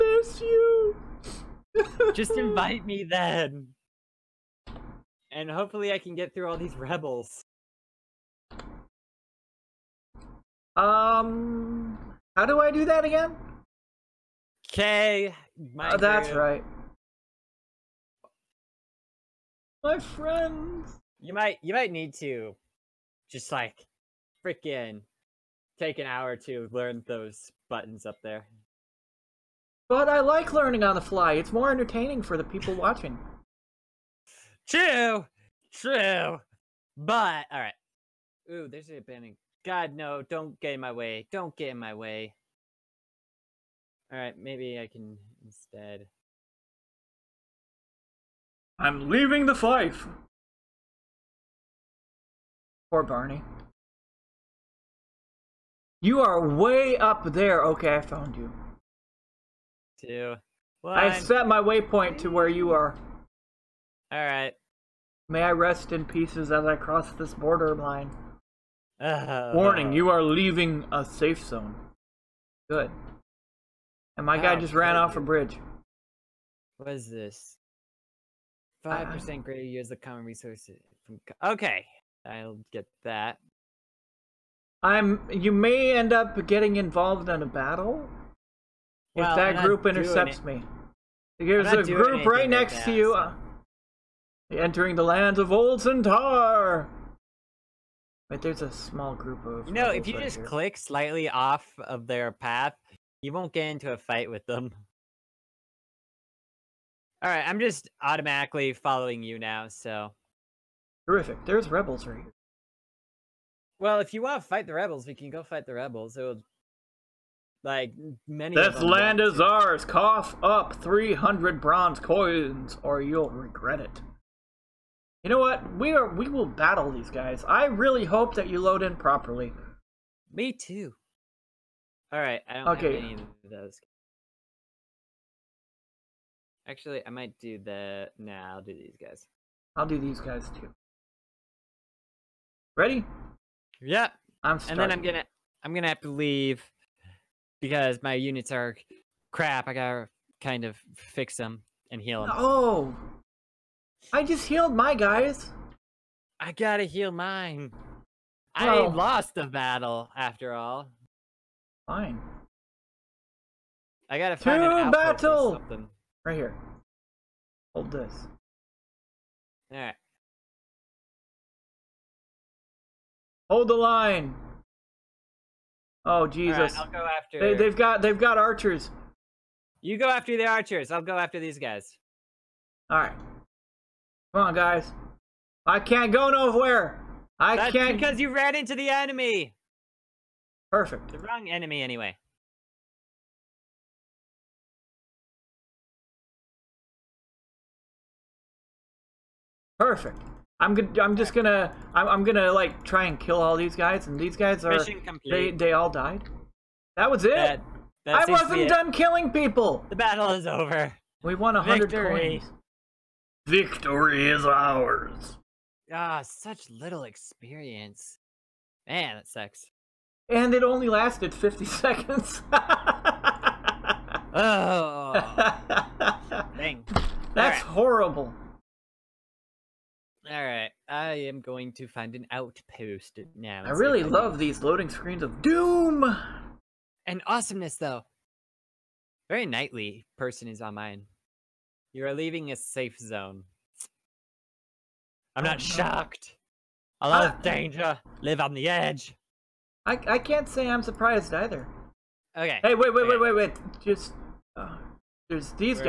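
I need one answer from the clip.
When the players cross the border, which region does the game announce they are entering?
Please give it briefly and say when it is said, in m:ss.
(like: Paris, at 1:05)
Old Centaur, at 1:35.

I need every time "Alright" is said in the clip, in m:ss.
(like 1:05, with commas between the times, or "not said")
0:44, 1:04, 1:47, 3:50.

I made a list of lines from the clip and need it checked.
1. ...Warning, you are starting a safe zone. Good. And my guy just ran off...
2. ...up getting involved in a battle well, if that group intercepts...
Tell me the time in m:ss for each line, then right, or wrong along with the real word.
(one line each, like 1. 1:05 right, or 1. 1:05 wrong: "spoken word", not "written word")
1. 1:09 wrong: "leaving", not "starting"
2. 1:26 right.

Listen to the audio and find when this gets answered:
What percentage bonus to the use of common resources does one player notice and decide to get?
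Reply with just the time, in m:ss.
1:18.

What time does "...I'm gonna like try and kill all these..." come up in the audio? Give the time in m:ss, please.
3:22.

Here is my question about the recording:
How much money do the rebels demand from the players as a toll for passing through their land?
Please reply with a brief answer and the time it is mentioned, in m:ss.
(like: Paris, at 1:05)
300 bronze coins, at 2:00.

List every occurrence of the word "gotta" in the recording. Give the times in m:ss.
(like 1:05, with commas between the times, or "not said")
2:29, 2:36, 2:44.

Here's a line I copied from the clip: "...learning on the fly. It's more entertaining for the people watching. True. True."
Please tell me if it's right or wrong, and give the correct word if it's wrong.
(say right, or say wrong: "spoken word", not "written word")
right.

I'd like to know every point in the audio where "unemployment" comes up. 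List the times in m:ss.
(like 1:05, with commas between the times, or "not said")
not said.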